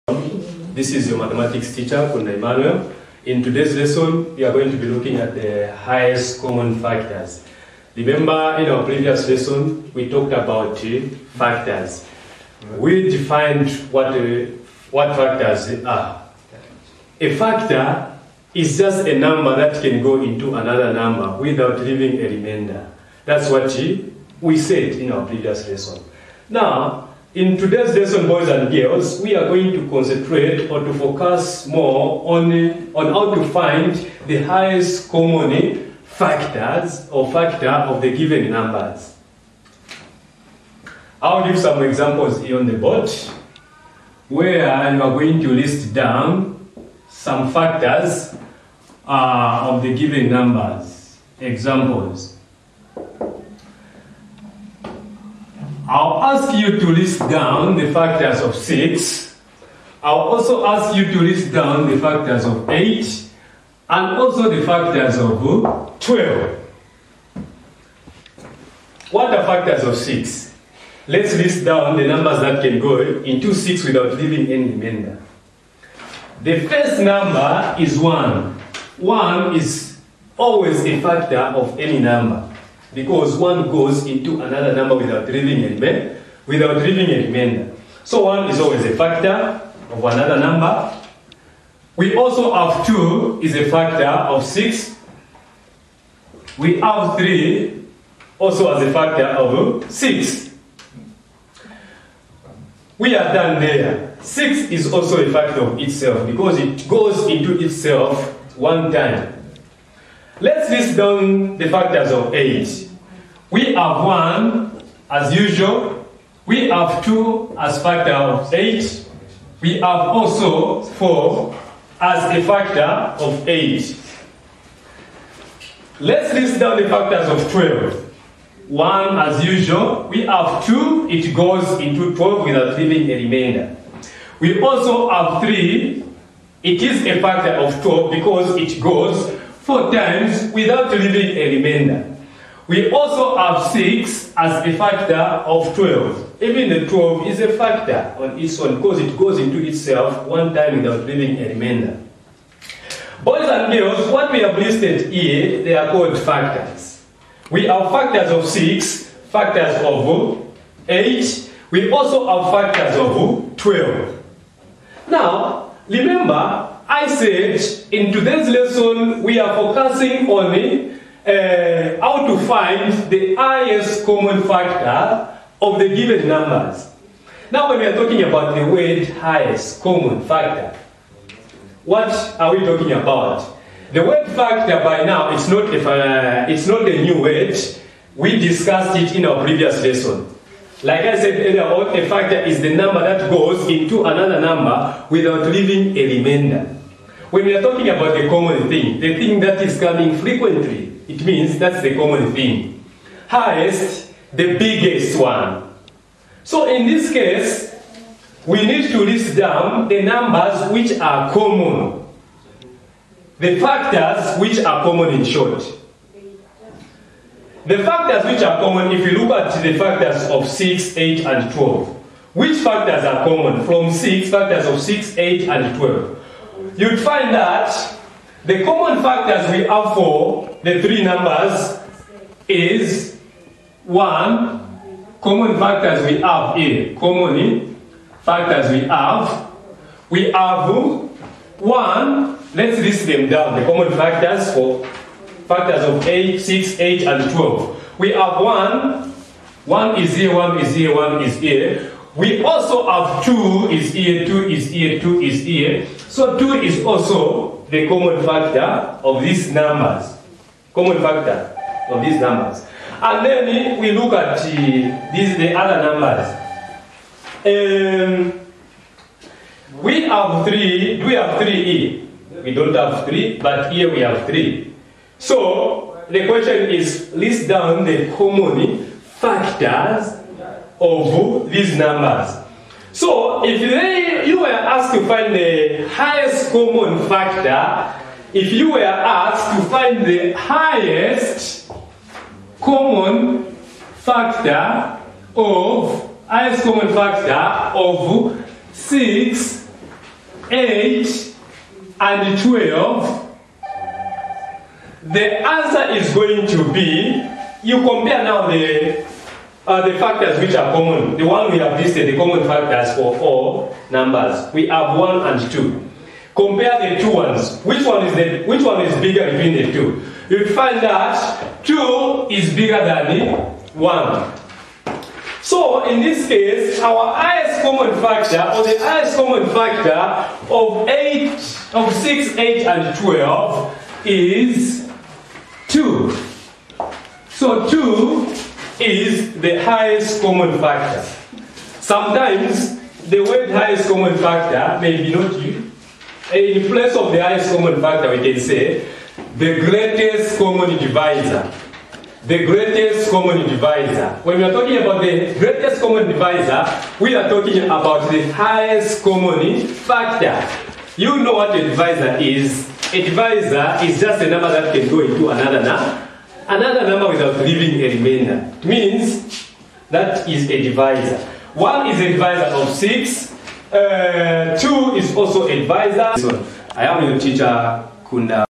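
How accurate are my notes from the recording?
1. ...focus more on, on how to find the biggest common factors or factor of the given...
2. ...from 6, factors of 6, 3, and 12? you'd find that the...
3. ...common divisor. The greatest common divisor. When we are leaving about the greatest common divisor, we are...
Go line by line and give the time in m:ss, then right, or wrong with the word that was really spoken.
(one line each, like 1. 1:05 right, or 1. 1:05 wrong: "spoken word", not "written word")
1. 0:30 wrong: "highest", not "biggest"
2. 3:43 wrong: "8", not "3"
3. 5:50 wrong: "talking", not "leaving".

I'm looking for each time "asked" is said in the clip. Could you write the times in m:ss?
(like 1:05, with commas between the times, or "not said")
4:44, 4:48.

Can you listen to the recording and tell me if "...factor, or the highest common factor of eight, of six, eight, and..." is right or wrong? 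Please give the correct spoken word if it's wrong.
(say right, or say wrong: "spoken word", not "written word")
right.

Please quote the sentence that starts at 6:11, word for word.
1 is a divisor of 6, uh, 2 is also a divisor.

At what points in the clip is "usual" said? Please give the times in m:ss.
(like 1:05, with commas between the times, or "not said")
1:55, 2:09.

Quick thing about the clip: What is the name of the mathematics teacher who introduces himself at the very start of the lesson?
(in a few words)
Kunda Emmanuel.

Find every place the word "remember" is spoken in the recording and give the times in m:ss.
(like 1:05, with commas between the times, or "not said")
0:07, 2:45.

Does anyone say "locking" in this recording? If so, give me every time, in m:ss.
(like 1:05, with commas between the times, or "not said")
not said.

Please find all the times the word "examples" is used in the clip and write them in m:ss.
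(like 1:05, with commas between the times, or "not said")
0:41, 0:51.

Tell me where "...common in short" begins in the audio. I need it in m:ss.
3:34.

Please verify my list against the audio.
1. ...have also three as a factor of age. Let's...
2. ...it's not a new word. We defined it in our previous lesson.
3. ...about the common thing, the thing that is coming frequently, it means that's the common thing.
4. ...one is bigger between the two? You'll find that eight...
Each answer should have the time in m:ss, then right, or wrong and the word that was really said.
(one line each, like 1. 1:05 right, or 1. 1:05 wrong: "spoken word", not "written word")
1. 1:59 wrong: "four", not "three"
2. 3:06 wrong: "discussed", not "defined"
3. 3:17 right
4. 5:18 wrong: "two", not "eight".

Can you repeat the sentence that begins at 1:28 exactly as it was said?
So one is always a factor of another number.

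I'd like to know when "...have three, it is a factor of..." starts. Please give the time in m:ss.
2:15.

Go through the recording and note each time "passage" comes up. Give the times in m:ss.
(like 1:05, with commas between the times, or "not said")
2:47.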